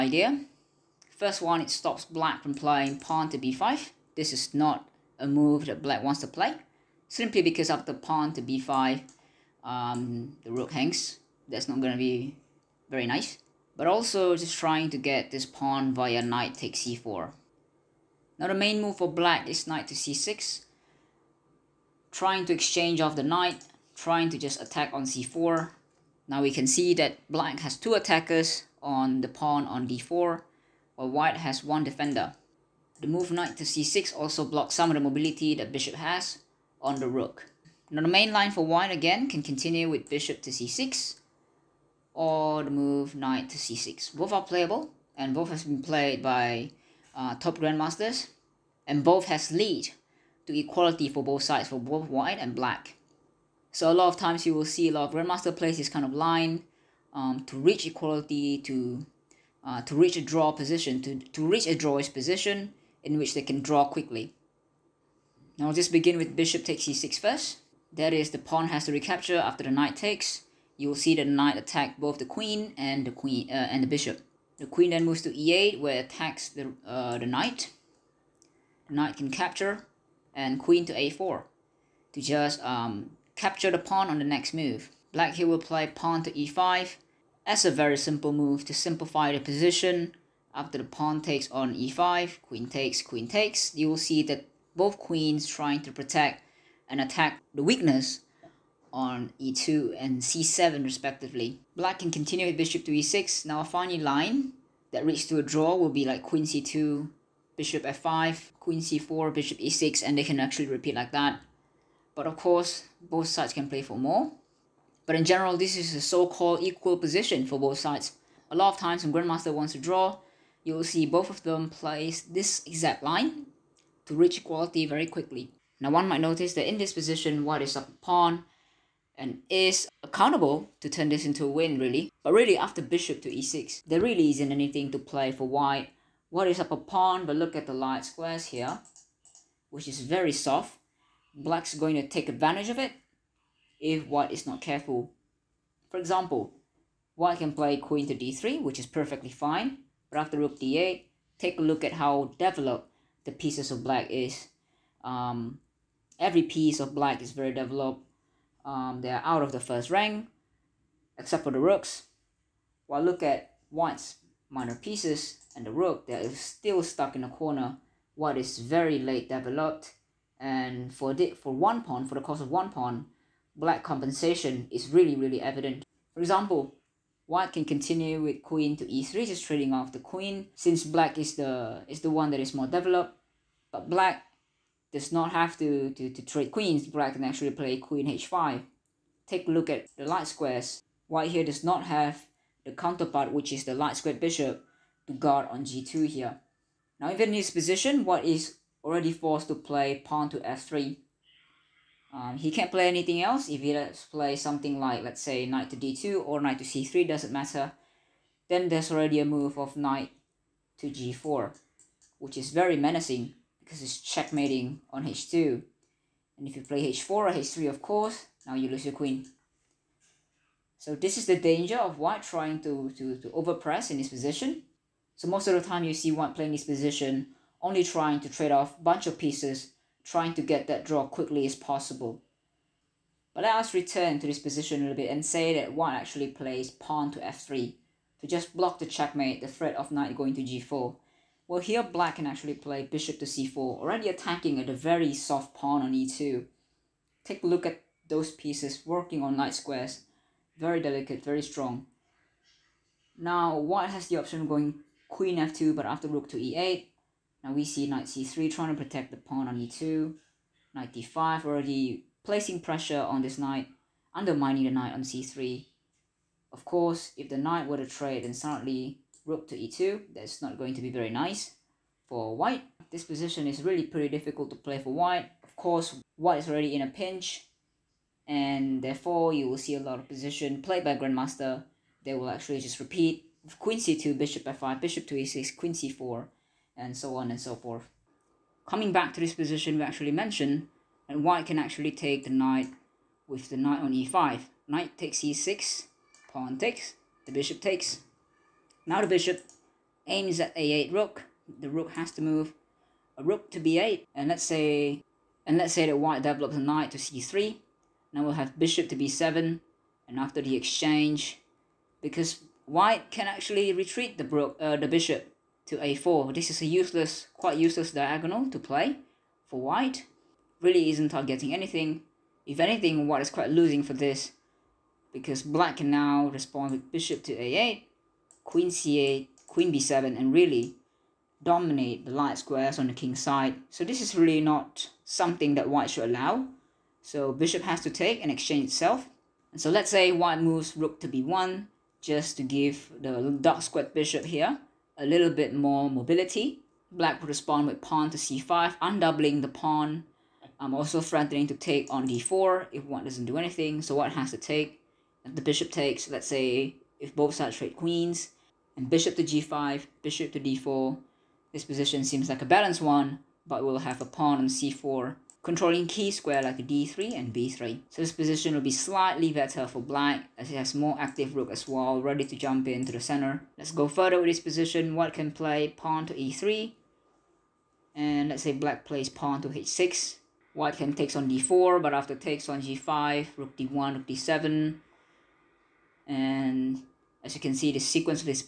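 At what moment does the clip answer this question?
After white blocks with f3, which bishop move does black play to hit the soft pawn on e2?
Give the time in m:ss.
4:02.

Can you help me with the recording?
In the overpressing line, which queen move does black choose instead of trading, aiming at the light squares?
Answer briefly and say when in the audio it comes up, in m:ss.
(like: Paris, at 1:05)
Queen h5, at 3:07.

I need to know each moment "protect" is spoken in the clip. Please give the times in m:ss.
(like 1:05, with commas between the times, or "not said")
1:35, 4:18.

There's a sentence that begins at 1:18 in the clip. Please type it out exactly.
The knight can capture, and queen to a4 to just um, capture the pawn on the next move.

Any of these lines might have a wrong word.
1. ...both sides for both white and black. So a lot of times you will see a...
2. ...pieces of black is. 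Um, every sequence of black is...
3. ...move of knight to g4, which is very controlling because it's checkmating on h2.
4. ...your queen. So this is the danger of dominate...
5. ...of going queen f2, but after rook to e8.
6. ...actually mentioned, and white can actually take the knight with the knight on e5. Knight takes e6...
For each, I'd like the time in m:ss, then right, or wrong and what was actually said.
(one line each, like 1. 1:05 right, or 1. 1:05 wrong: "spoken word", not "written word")
1. 0:51 right
2. 2:33 wrong: "piece", not "sequence"
3. 3:29 wrong: "menacing", not "controlling"
4. 3:38 wrong: "white", not "dominate"
5. 4:14 right
6. 4:49 right.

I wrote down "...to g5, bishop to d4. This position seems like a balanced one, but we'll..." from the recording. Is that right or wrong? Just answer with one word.
right.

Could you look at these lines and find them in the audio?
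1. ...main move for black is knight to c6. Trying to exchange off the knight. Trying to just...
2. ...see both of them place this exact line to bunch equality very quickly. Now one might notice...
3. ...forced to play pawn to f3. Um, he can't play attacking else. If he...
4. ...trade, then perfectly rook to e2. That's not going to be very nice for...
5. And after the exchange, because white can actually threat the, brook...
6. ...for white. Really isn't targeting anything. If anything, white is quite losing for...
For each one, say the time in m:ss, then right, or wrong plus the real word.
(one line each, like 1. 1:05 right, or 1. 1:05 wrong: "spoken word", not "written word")
1. 0:18 right
2. 2:00 wrong: "reach", not "bunch"
3. 3:19 wrong: "anything", not "attacking"
4. 4:27 wrong: "suddenly", not "perfectly"
5. 5:10 wrong: "retreat", not "threat"
6. 5:19 right.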